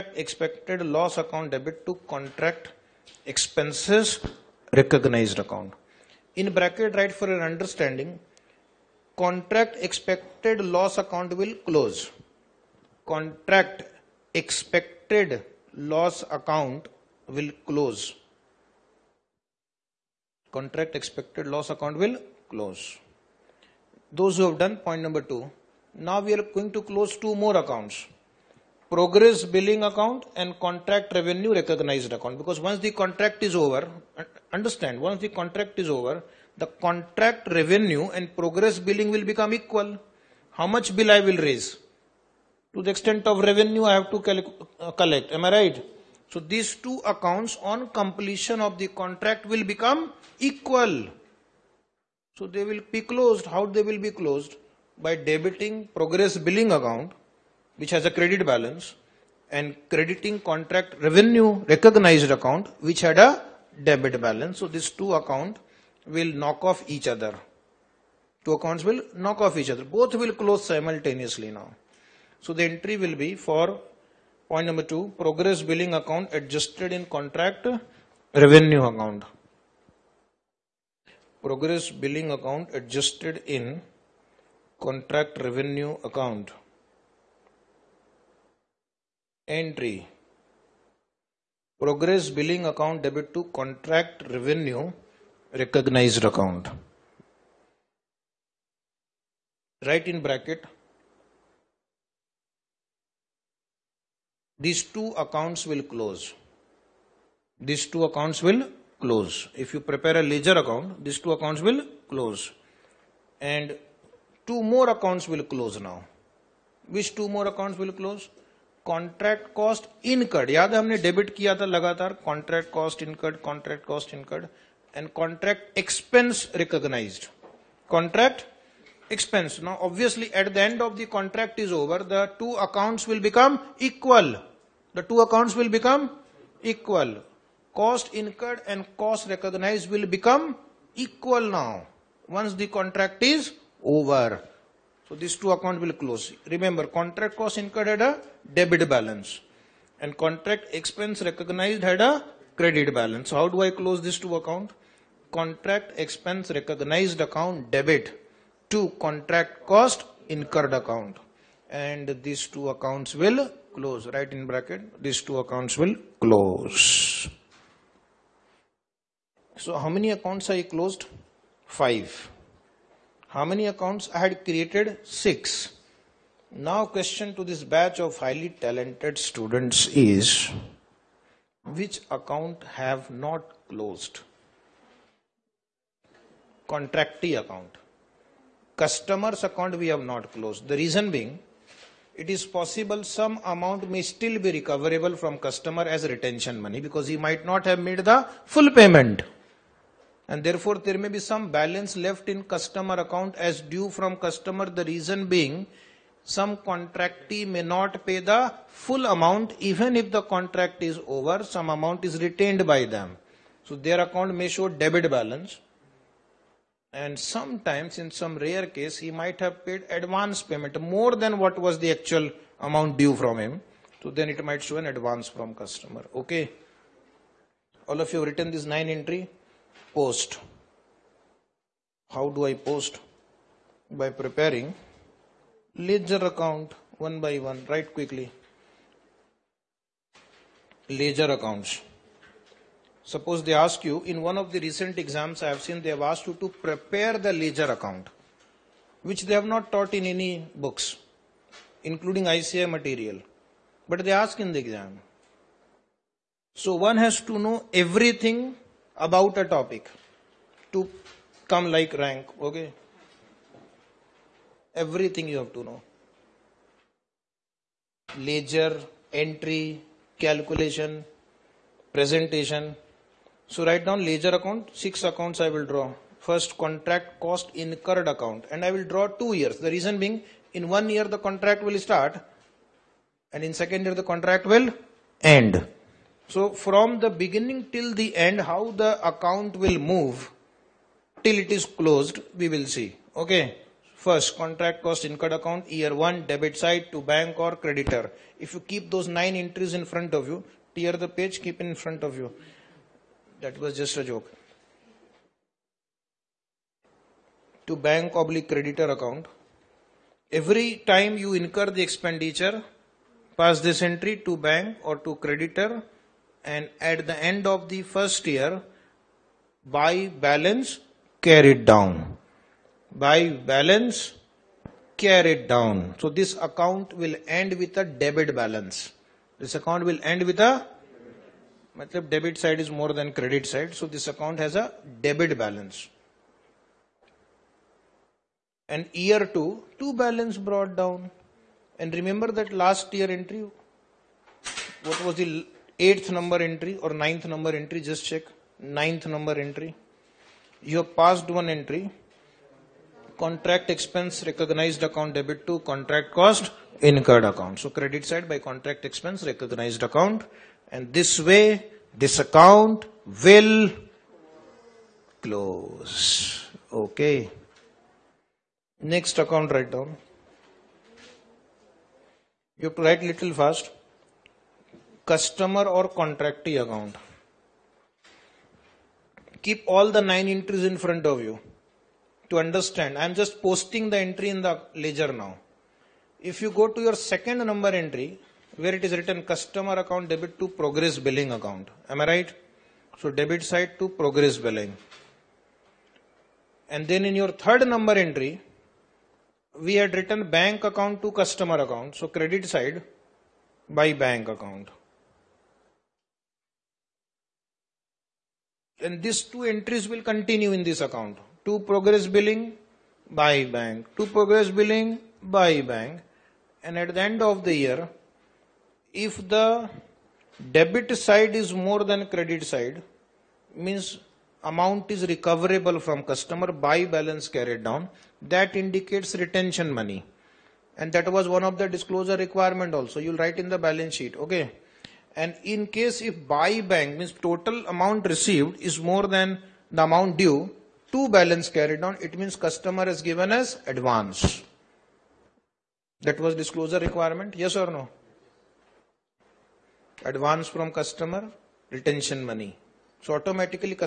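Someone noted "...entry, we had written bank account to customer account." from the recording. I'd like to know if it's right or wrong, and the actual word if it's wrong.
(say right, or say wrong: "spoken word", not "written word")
right.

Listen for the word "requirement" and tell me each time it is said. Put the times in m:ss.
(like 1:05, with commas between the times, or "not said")
7:12, 7:26.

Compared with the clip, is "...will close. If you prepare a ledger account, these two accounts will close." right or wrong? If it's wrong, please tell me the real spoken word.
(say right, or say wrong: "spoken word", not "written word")
right.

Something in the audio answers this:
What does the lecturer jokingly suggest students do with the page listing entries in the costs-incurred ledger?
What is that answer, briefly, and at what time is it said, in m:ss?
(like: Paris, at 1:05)
Tear the page, at 5:00.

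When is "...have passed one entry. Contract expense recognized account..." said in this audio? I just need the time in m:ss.
5:50.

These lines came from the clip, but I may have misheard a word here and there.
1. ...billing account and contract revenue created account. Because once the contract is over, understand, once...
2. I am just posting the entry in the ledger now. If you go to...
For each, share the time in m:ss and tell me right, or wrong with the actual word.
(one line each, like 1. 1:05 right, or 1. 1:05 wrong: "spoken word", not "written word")
1. 0:29 wrong: "recognized", not "created"
2. 6:22 right.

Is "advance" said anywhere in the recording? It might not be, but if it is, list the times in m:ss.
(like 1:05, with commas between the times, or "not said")
3:39, 3:44, 7:23, 7:30.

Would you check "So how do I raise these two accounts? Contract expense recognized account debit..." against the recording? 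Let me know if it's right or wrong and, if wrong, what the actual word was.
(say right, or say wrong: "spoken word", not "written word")
wrong: "close", not "raise".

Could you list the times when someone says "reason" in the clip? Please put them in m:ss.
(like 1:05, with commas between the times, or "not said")
3:10, 3:24, 4:39.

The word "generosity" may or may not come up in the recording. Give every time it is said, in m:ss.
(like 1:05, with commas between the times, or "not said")
not said.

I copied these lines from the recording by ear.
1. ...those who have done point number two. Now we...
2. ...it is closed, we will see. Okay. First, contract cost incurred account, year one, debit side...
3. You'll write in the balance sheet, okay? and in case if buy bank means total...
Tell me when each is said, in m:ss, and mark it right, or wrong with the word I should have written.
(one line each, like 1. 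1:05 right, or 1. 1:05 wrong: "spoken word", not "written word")
1. 0:24 right
2. 4:51 right
3. 7:12 right.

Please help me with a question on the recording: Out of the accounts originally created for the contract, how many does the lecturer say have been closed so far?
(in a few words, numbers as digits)
5.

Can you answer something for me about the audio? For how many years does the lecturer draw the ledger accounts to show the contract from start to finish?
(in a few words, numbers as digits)
2.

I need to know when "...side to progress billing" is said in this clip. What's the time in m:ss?
6:33.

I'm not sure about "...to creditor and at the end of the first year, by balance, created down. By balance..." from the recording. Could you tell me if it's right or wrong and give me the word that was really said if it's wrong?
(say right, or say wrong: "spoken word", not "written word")
wrong: "carried", not "created".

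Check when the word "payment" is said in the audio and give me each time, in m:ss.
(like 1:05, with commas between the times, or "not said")
3:18, 3:40.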